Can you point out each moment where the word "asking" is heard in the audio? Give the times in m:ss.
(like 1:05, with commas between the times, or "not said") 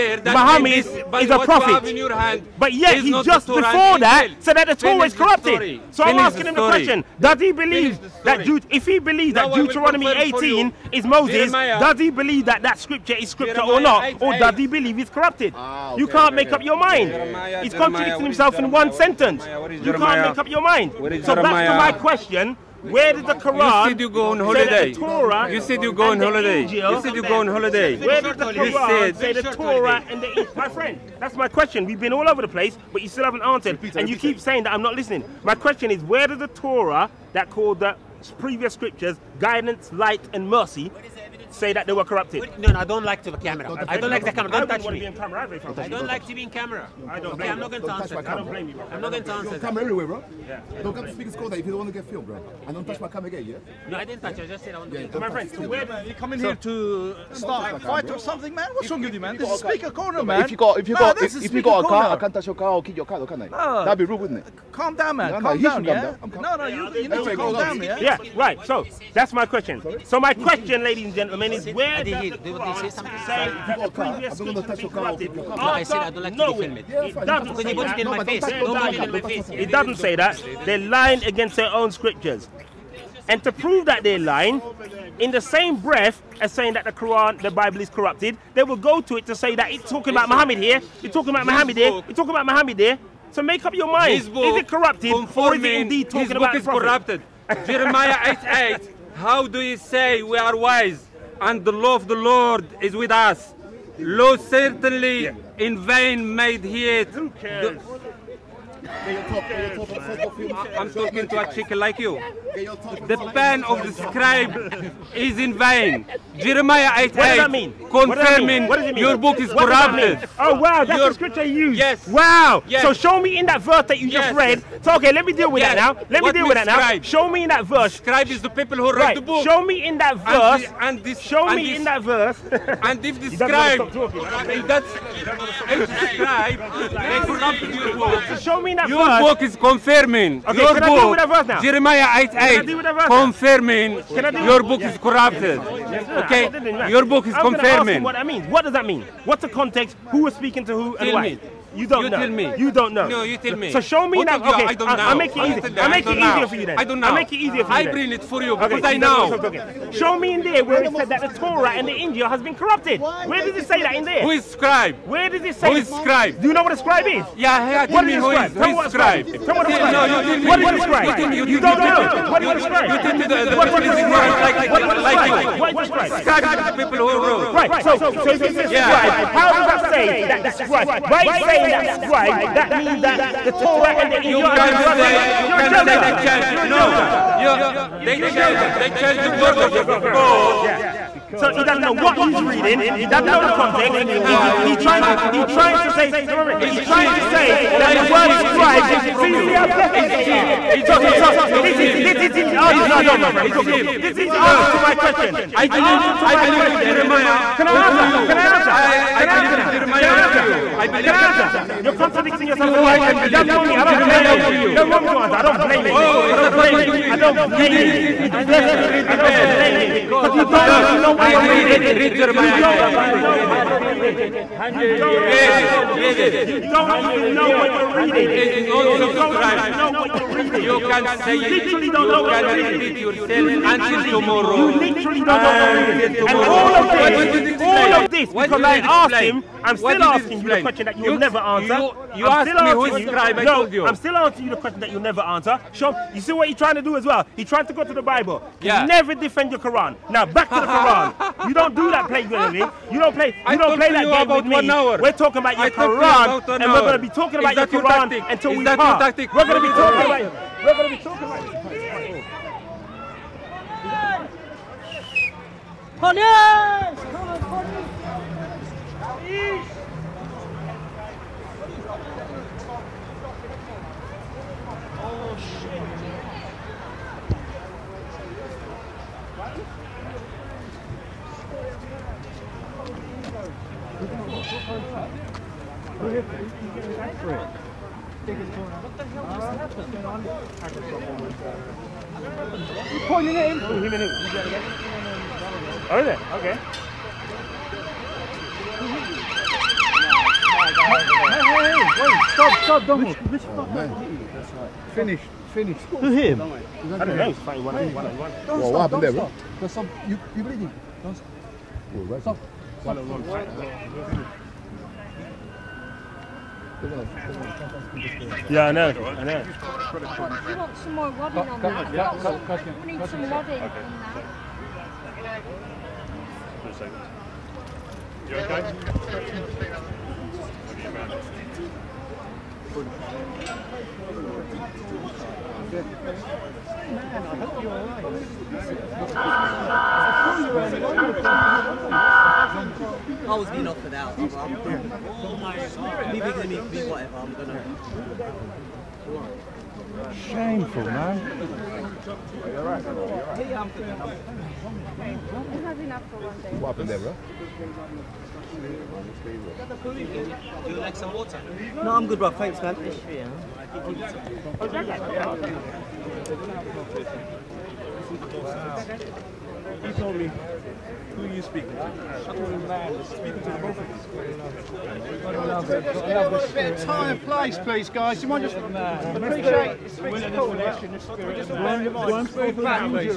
0:06, 4:00.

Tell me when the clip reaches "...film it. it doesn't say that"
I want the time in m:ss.
1:16.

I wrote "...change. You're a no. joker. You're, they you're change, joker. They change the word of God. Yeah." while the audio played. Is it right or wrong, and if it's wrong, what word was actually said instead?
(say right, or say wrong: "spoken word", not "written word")
right.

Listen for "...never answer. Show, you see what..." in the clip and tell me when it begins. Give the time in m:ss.
4:04.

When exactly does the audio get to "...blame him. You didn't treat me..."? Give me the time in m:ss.
3:37.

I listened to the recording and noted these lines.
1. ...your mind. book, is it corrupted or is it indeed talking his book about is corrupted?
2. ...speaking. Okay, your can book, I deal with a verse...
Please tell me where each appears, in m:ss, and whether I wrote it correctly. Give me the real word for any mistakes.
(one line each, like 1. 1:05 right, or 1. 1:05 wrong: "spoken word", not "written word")
1. 1:33 right
2. 2:19 wrong: "confirming", not "speaking".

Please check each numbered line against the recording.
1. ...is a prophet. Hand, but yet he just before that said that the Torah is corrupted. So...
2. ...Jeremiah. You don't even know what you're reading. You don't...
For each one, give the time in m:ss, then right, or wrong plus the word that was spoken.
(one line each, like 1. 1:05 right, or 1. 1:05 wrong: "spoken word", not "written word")
1. 0:00 right
2. 3:42 right.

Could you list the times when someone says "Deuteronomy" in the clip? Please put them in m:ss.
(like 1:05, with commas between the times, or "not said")
0:09.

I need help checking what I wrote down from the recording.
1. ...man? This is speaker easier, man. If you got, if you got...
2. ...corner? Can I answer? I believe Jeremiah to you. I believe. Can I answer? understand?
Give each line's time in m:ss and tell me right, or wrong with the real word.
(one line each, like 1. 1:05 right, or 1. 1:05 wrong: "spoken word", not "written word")
1. 0:59 wrong: "corner", not "easier"
2. 3:27 wrong: "answer", not "corner".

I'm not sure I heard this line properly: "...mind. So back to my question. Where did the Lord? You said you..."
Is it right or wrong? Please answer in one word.
wrong.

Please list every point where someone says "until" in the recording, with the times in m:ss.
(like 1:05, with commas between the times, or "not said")
3:53, 4:18.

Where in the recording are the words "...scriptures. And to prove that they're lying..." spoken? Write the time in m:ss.
1:21.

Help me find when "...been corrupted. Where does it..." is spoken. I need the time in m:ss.
2:42.